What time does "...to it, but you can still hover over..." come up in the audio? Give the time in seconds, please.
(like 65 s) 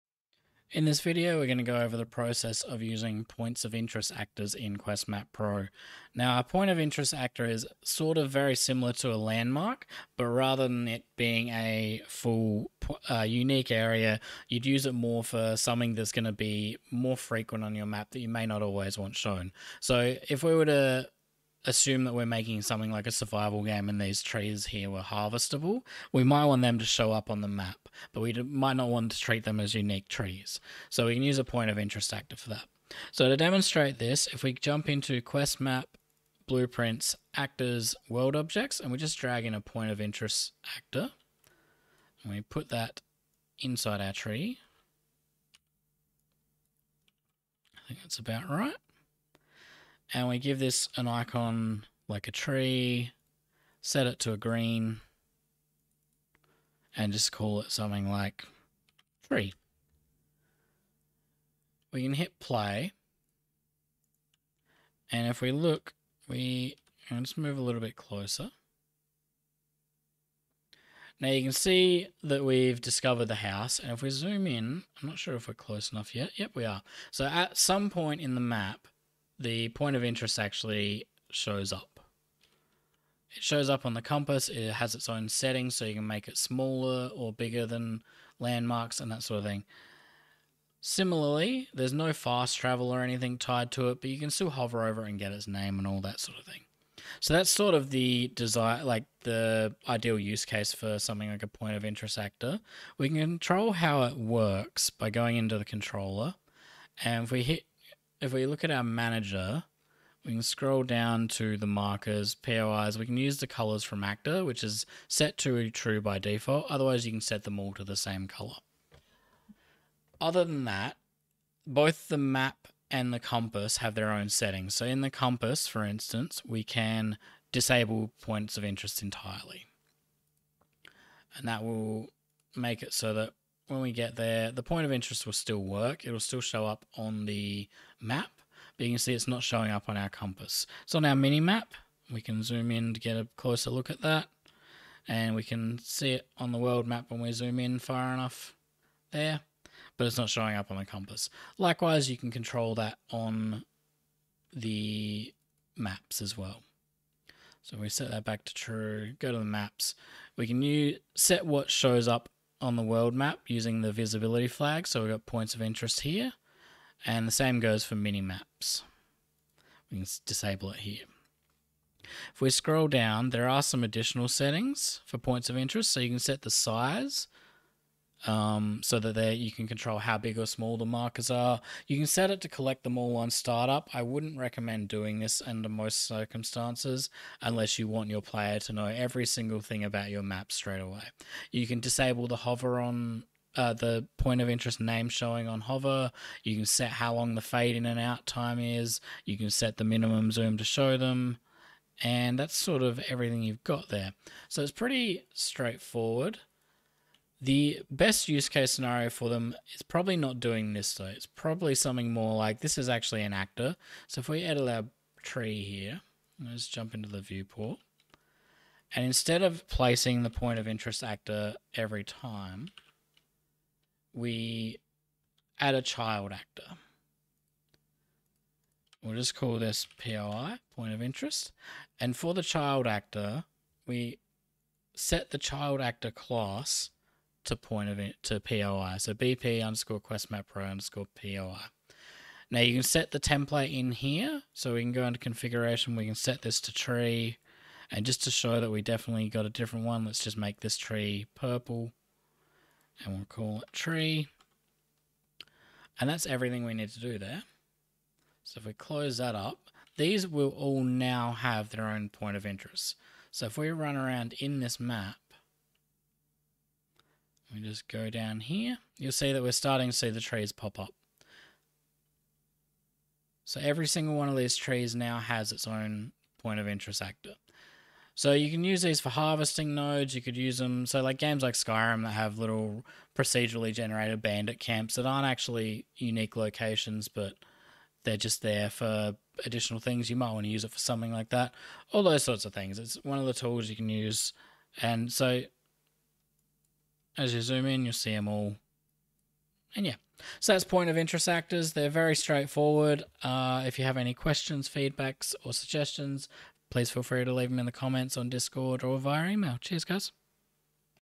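93 s.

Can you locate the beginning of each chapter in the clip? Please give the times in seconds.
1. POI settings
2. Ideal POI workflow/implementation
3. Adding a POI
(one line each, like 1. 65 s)
1. 102 s
2. 207 s
3. 33 s.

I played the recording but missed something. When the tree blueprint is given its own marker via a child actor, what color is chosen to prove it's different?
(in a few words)
Purple.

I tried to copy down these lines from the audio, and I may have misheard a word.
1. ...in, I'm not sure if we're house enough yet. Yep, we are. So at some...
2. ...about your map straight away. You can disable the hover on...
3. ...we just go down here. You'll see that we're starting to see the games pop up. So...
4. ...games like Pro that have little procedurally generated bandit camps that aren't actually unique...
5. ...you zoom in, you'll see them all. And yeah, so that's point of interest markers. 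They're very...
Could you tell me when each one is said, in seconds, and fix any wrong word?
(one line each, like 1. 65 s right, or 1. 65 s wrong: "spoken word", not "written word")
1. 74 s wrong: "close", not "house"
2. 189 s right
3. 267 s wrong: "trees", not "games"
4. 281 s wrong: "Skyrim", not "Pro"
5. 297 s wrong: "actors", not "markers".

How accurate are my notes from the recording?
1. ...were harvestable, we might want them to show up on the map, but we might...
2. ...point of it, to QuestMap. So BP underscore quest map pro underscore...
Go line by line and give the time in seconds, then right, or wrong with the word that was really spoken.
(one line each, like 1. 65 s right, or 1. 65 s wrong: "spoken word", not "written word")
1. 24 s right
2. 237 s wrong: "POI", not "QuestMap".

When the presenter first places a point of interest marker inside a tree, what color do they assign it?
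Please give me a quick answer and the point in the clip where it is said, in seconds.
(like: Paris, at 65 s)
Green, at 54 s.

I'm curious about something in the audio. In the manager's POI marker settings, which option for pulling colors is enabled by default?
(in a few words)
Colors from actor.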